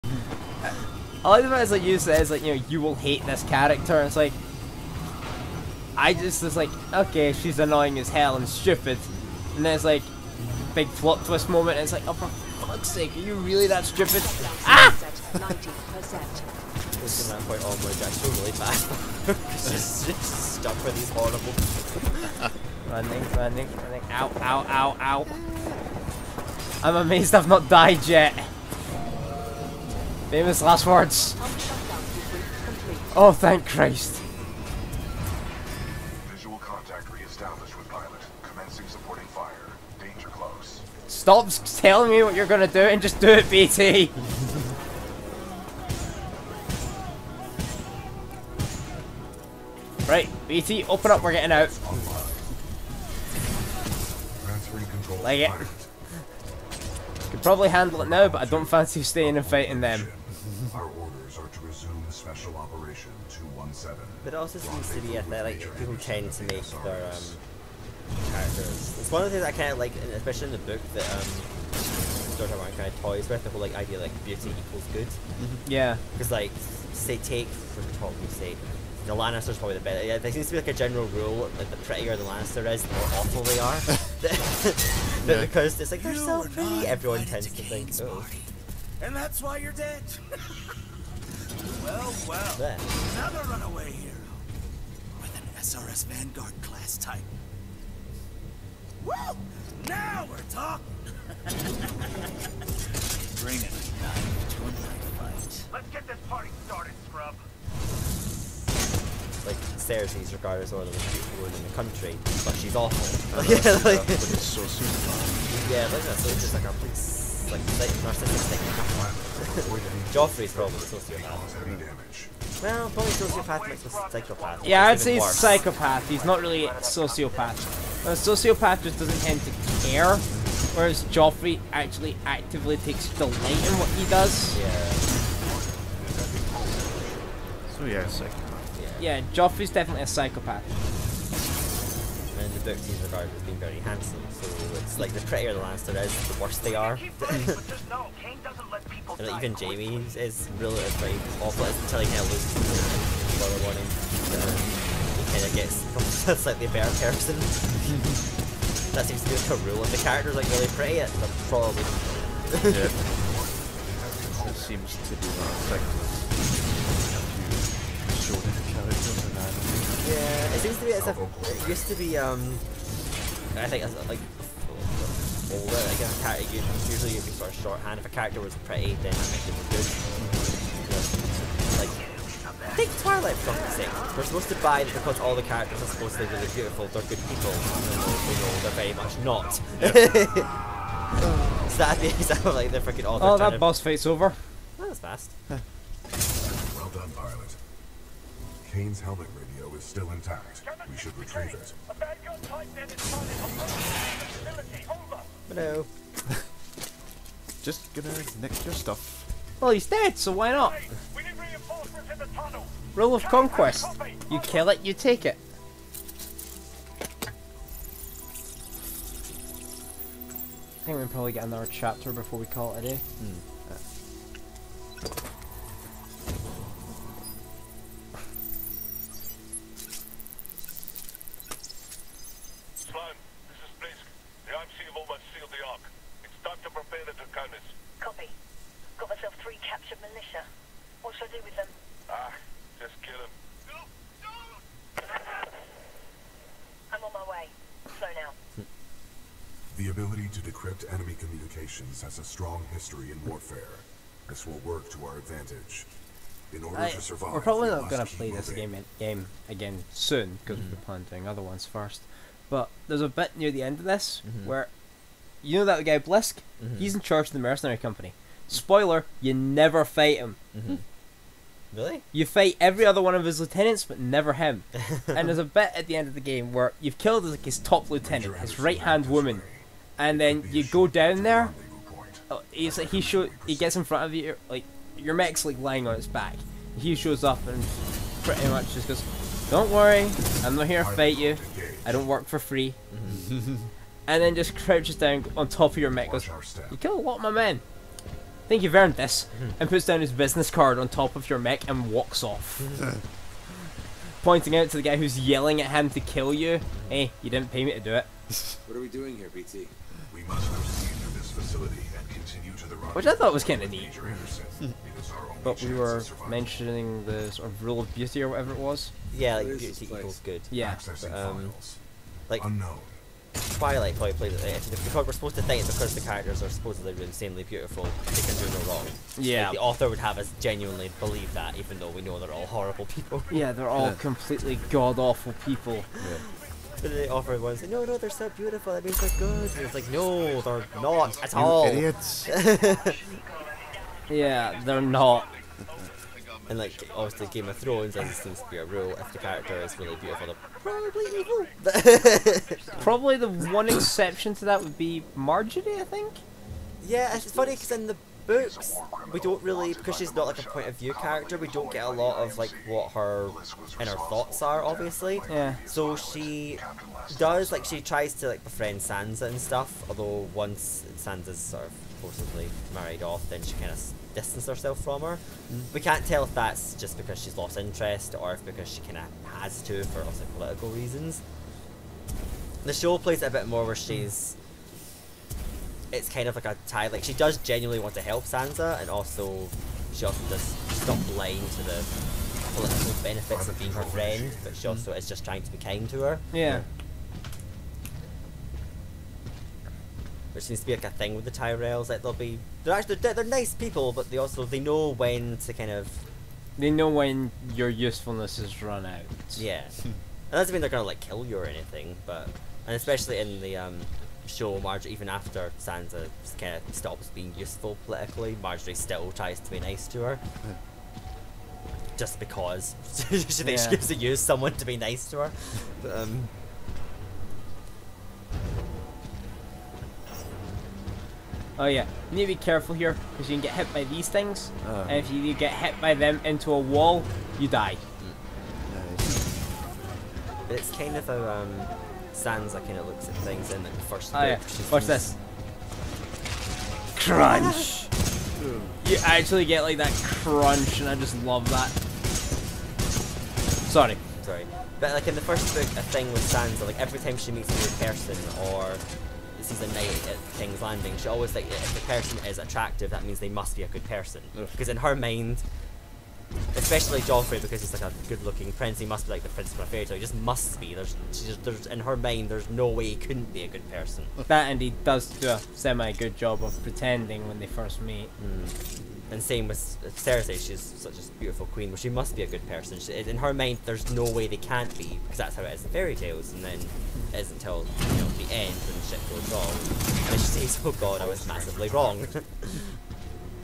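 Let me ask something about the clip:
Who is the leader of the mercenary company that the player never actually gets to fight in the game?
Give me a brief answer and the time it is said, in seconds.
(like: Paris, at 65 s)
Blisk, at 265 s.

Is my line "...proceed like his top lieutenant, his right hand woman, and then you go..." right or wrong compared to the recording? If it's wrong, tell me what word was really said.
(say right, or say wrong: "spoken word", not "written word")
wrong: "killed", not "proceed".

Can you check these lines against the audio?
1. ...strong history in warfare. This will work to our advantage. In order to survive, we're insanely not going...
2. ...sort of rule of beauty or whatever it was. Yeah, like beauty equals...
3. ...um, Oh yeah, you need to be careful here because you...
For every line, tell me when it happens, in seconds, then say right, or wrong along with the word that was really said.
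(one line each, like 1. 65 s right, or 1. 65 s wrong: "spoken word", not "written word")
1. 252 s wrong: "probably", not "insanely"
2. 317 s right
3. 425 s right.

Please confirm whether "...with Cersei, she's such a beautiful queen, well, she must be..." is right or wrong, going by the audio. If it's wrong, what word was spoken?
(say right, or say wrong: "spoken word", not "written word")
right.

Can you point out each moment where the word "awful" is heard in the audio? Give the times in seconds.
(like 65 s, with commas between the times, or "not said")
83 s, 112 s, 151 s, 334 s.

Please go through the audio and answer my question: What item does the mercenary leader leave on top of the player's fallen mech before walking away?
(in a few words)
His business card.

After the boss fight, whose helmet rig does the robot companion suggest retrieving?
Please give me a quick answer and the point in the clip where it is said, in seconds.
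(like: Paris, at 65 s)
Kane, at 198 s.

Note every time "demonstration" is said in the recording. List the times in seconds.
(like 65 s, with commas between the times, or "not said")
not said.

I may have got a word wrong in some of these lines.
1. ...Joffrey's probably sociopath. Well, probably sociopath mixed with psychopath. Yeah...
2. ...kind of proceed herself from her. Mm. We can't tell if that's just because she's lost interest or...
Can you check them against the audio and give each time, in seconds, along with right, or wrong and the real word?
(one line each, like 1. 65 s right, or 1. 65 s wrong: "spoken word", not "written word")
1. 120 s right
2. 373 s wrong: "distanced", not "proceed".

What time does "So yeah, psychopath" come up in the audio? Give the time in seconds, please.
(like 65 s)
137 s.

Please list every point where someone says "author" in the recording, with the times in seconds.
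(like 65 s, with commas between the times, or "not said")
329 s, 337 s.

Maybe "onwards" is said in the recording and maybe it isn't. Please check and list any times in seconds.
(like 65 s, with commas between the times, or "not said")
17 s.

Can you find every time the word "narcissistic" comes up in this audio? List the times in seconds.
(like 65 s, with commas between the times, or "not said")
118 s.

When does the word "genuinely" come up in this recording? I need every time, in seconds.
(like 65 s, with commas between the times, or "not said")
330 s, 387 s.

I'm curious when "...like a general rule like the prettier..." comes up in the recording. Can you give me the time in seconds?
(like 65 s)
80 s.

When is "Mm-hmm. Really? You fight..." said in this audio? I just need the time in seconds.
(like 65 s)
270 s.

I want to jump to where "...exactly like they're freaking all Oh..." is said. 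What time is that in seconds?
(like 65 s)
192 s.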